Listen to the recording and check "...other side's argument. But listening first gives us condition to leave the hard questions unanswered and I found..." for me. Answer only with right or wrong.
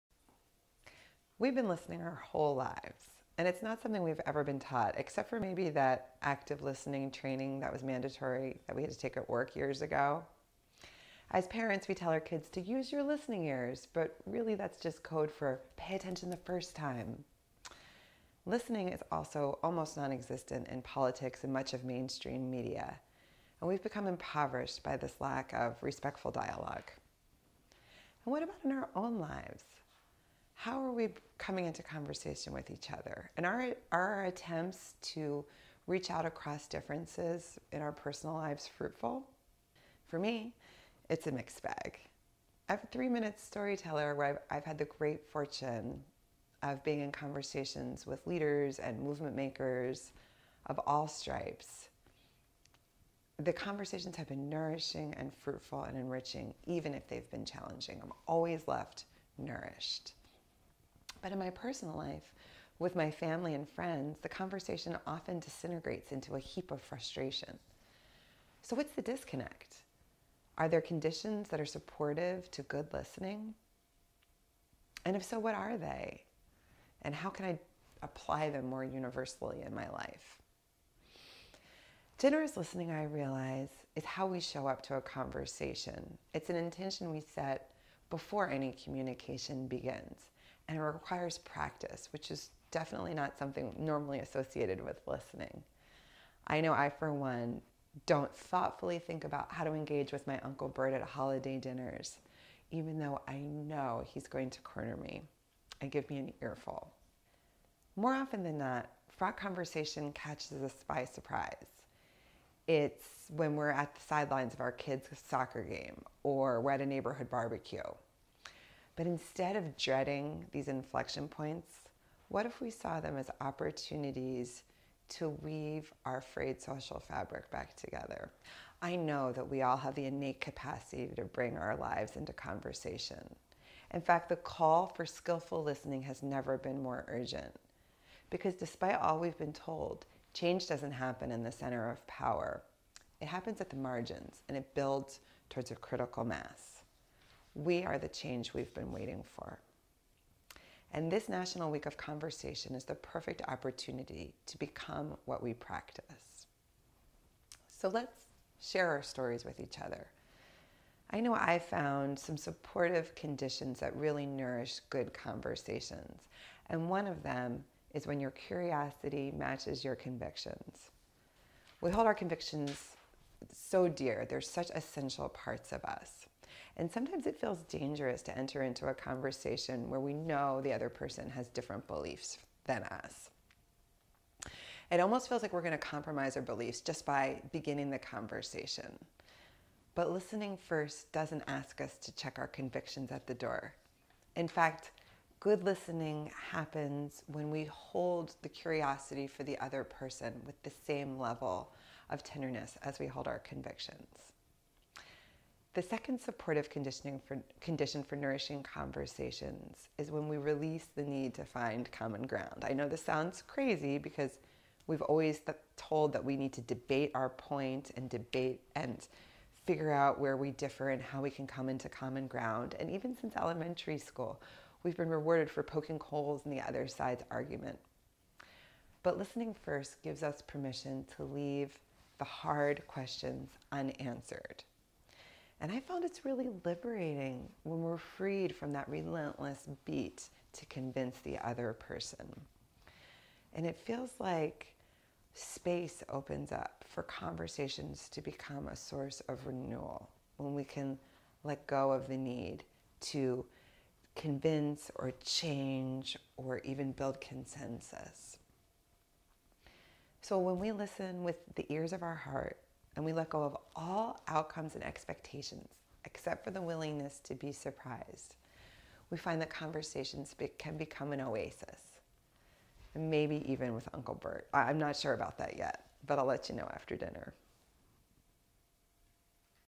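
wrong.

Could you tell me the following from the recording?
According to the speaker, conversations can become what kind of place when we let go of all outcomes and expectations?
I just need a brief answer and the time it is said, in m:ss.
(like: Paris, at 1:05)
An oasis, at 4:31.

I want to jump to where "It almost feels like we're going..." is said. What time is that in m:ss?
3:04.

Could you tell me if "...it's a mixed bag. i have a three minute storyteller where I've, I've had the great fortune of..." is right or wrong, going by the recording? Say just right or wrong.
right.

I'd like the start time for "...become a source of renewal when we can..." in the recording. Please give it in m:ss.
4:08.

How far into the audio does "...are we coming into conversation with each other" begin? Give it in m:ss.
0:30.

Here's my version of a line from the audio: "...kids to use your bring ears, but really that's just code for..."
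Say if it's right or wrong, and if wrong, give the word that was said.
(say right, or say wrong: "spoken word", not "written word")
wrong: "listening", not "bring".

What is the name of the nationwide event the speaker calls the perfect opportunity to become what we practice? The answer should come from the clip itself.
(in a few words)
National Week of Conversation.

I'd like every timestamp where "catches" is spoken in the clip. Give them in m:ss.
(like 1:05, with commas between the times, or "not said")
1:50.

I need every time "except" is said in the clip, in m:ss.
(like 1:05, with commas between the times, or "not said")
0:04, 4:26.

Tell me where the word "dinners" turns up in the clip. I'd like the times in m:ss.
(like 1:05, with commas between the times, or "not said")
1:41, 4:36.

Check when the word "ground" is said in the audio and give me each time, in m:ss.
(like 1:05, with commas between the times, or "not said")
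3:32, 3:42.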